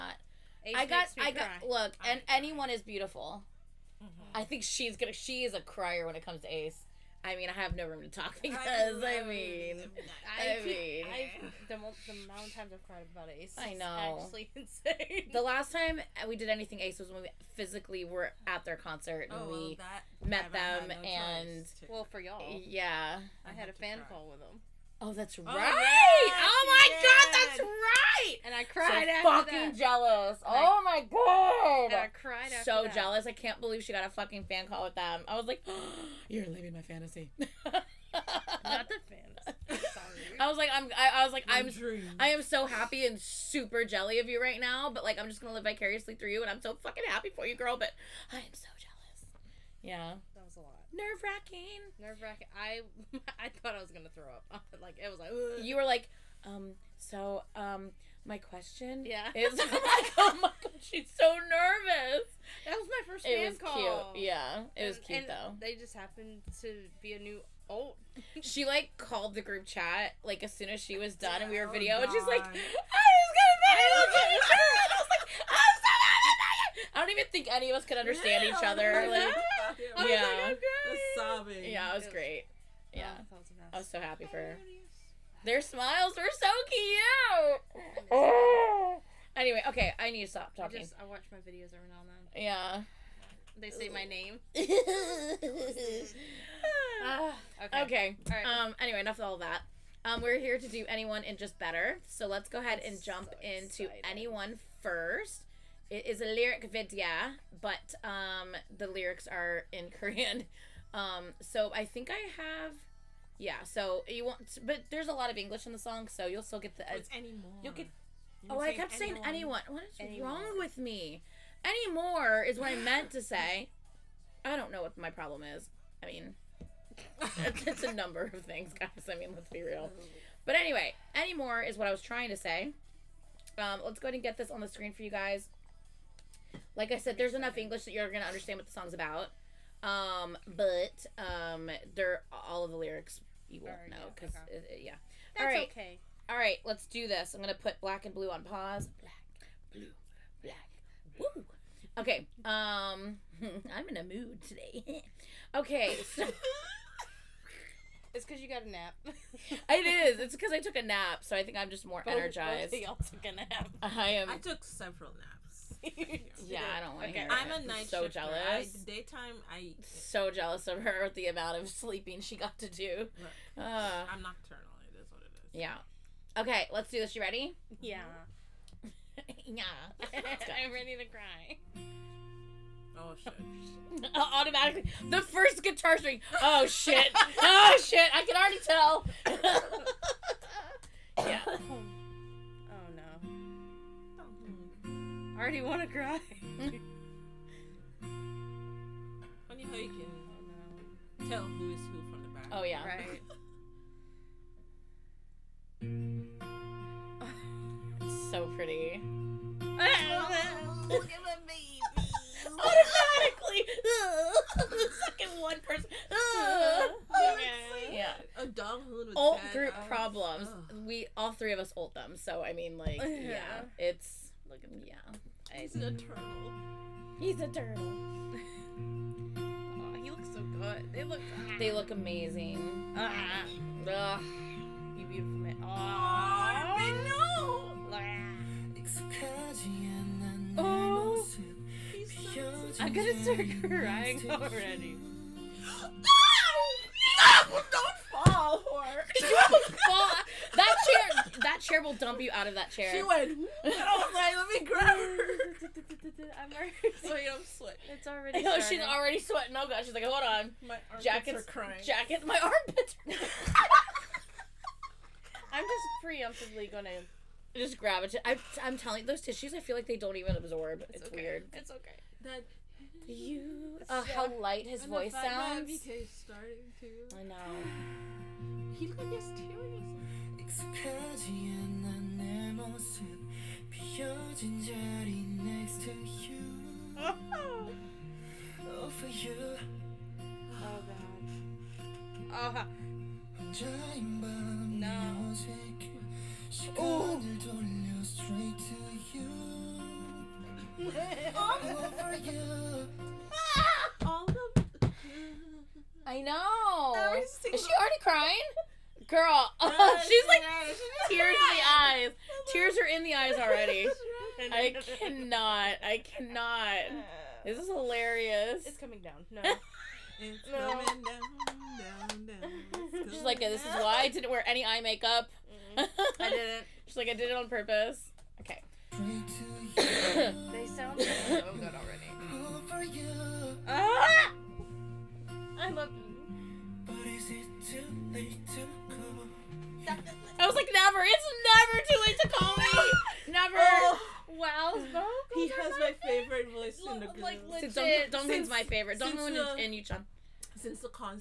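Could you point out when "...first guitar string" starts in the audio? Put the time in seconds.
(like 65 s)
185 s.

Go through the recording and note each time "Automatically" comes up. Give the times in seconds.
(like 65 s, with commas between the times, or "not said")
184 s, 212 s.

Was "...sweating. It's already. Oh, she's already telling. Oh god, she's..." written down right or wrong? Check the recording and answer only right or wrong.
wrong.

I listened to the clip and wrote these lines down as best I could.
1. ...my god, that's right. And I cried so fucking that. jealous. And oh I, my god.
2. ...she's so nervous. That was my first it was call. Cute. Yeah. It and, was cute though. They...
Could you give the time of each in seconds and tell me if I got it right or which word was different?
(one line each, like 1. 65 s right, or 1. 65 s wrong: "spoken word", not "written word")
1. 26 s right
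2. 60 s right.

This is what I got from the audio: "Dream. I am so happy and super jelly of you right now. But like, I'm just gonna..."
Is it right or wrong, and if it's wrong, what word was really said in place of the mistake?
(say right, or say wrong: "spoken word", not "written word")
right.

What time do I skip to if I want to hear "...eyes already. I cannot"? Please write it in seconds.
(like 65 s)
313 s.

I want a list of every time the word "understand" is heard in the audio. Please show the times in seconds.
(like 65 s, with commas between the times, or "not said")
77 s, 138 s.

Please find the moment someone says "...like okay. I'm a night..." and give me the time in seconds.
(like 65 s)
166 s.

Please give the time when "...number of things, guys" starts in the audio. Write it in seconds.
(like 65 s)
127 s.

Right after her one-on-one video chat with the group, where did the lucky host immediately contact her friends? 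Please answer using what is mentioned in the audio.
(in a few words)
group chat.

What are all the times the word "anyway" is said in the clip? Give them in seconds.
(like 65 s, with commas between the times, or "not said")
89 s, 98 s, 130 s.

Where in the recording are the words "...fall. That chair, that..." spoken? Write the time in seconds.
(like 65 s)
249 s.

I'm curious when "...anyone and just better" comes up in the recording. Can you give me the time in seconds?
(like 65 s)
100 s.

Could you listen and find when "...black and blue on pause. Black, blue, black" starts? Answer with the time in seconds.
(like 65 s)
147 s.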